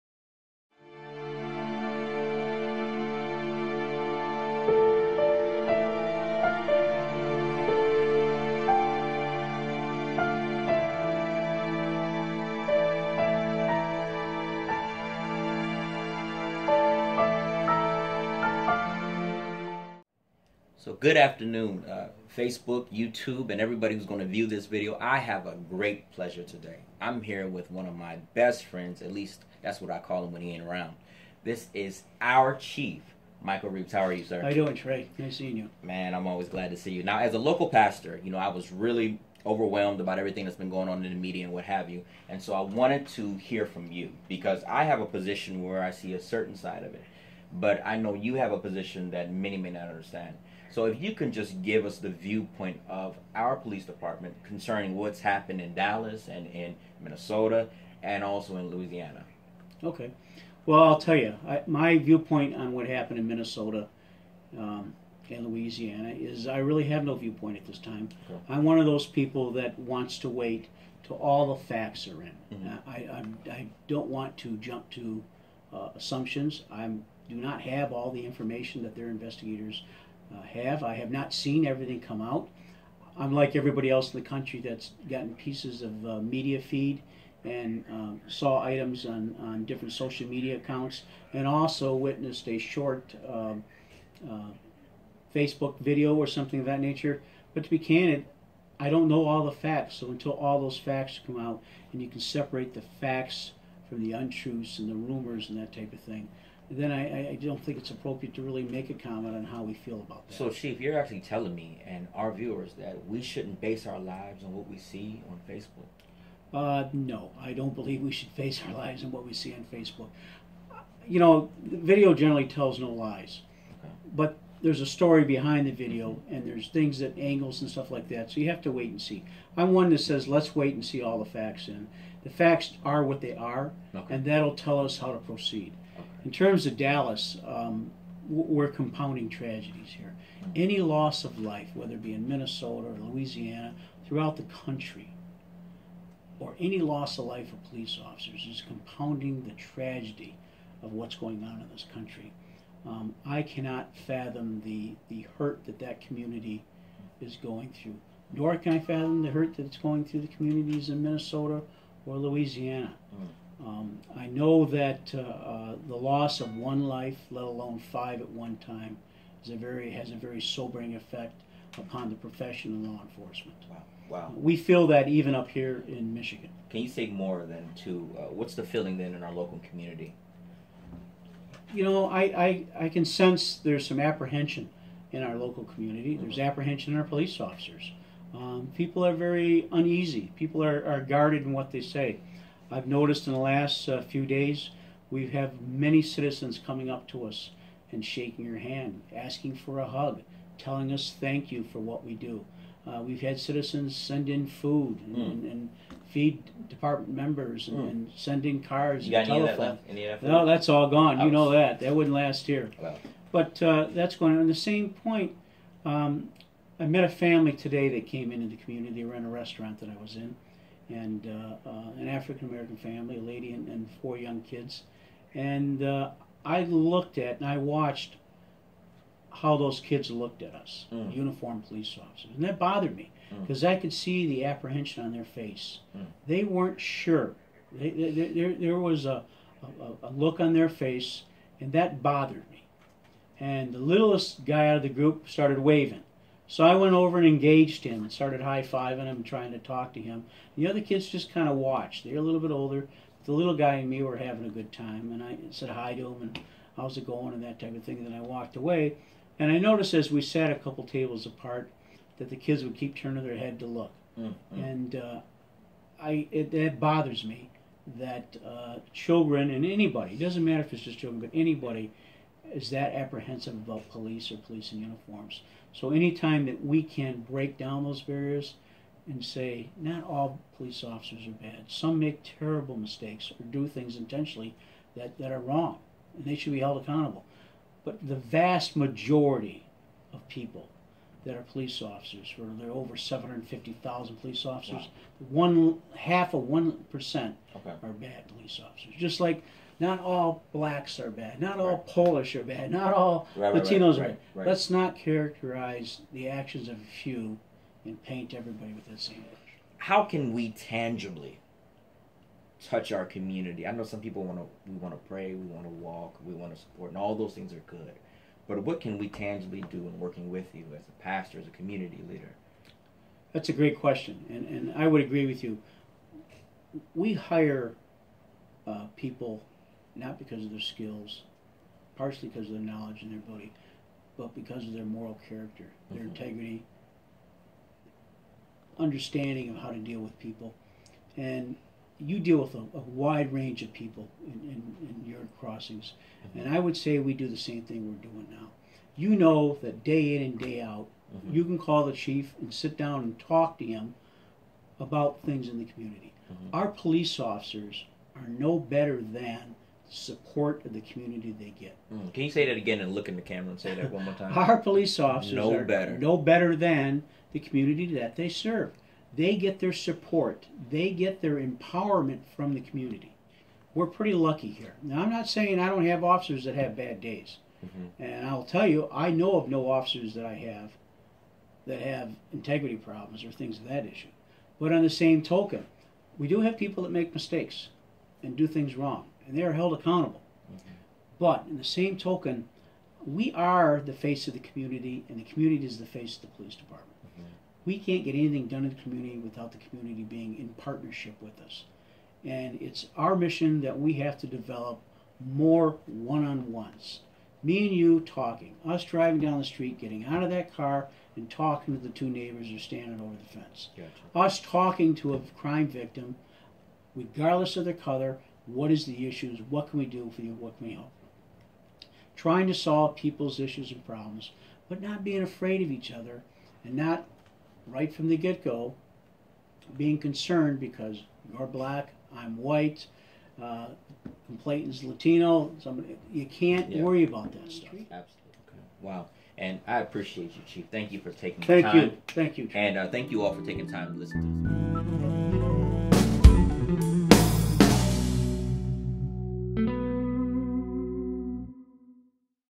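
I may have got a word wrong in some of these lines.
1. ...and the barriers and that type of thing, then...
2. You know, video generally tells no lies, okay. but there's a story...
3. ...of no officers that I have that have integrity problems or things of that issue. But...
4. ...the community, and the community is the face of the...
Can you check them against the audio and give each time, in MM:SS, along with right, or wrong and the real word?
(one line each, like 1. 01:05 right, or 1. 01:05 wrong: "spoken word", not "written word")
1. 01:44 wrong: "rumors", not "barriers"
2. 02:01 right
3. 06:19 right
4. 06:34 right.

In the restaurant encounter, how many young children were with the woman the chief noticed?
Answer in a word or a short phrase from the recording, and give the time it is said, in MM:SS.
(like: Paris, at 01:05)
4, at 03:44.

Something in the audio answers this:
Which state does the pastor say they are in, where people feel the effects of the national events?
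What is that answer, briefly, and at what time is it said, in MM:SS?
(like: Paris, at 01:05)
Michigan, at 02:56.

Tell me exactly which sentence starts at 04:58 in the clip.
Just like not all blacks are bad, not all Polish are bad, not all right, Latinos right, are bad.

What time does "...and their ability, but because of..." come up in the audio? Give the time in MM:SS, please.
05:33.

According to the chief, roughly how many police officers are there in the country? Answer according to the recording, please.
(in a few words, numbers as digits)
750,000.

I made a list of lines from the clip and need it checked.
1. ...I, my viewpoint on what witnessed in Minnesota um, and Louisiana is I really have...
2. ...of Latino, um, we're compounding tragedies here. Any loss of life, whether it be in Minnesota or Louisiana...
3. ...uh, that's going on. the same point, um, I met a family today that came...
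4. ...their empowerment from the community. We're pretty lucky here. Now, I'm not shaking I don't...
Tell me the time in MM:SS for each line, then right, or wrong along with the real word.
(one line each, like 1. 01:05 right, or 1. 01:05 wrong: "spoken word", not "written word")
1. 01:01 wrong: "happened", not "witnessed"
2. 02:16 wrong: "Dallas", not "Latino"
3. 03:33 right
4. 06:11 wrong: "saying", not "shaking".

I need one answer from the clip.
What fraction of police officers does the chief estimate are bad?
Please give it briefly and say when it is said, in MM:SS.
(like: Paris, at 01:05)
one half of 1%, at 04:55.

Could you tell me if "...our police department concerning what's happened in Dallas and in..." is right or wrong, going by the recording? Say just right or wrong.
right.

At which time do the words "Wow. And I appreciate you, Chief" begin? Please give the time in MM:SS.
07:18.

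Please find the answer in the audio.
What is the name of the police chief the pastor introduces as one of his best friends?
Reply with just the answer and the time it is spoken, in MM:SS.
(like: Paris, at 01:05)
Michael Reaves, at 00:33.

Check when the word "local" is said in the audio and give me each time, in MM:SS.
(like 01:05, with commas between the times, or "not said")
00:37, 02:59, 03:05.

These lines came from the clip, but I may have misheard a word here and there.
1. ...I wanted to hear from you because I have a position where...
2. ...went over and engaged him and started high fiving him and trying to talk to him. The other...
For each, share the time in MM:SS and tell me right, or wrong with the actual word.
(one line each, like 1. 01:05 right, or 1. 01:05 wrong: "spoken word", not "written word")
1. 00:42 right
2. 04:06 right.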